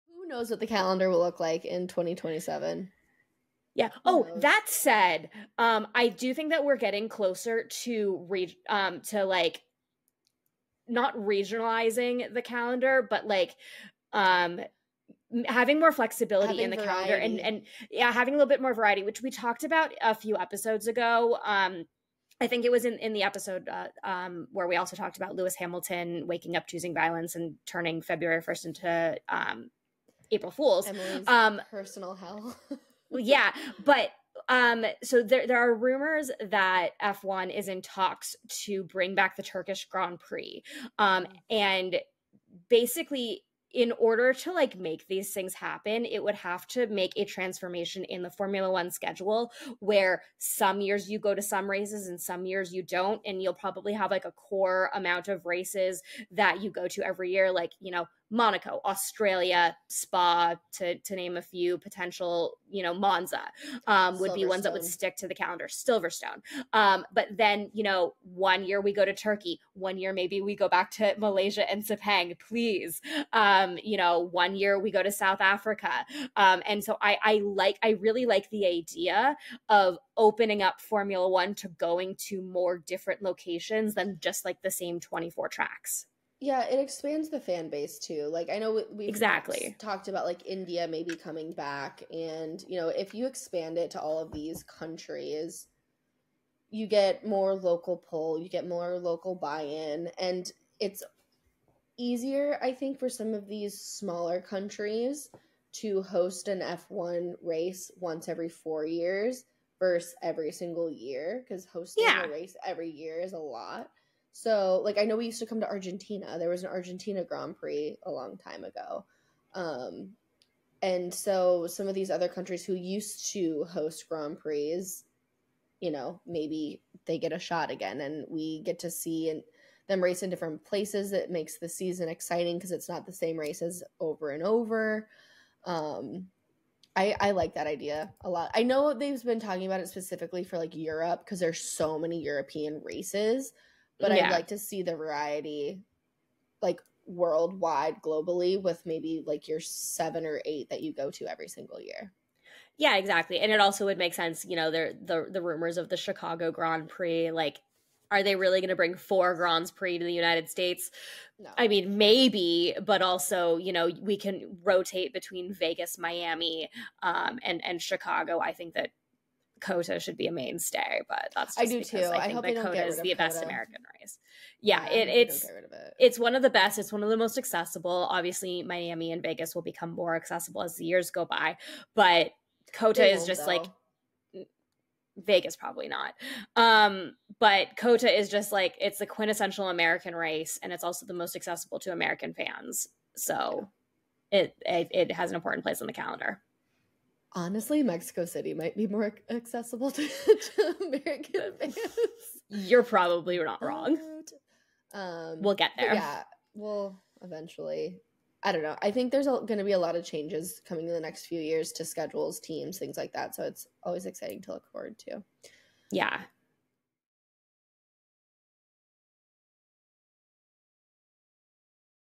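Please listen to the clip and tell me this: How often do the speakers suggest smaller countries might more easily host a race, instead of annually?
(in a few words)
once every 4 years.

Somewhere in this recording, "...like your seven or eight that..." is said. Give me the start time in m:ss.
2:29.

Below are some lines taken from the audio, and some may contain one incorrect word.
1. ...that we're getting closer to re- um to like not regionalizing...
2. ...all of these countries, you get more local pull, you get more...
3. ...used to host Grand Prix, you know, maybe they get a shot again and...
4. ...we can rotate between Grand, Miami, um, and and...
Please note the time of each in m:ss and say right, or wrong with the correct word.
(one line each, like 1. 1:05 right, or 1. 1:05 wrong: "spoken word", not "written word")
1. 0:06 right
2. 1:34 right
3. 2:02 right
4. 2:44 wrong: "Vegas", not "Grand".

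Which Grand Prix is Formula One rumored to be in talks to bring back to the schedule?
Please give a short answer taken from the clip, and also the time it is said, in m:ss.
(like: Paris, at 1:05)
Turkish Grand Prix, at 0:39.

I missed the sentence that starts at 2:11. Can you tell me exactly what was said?
It makes the season exciting because it's not the same races over and over.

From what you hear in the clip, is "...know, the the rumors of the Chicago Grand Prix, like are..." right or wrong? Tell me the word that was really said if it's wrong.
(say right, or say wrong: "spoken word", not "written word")
right.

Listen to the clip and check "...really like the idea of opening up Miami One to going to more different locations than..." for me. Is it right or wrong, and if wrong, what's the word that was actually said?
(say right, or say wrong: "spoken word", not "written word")
wrong: "Formula", not "Miami".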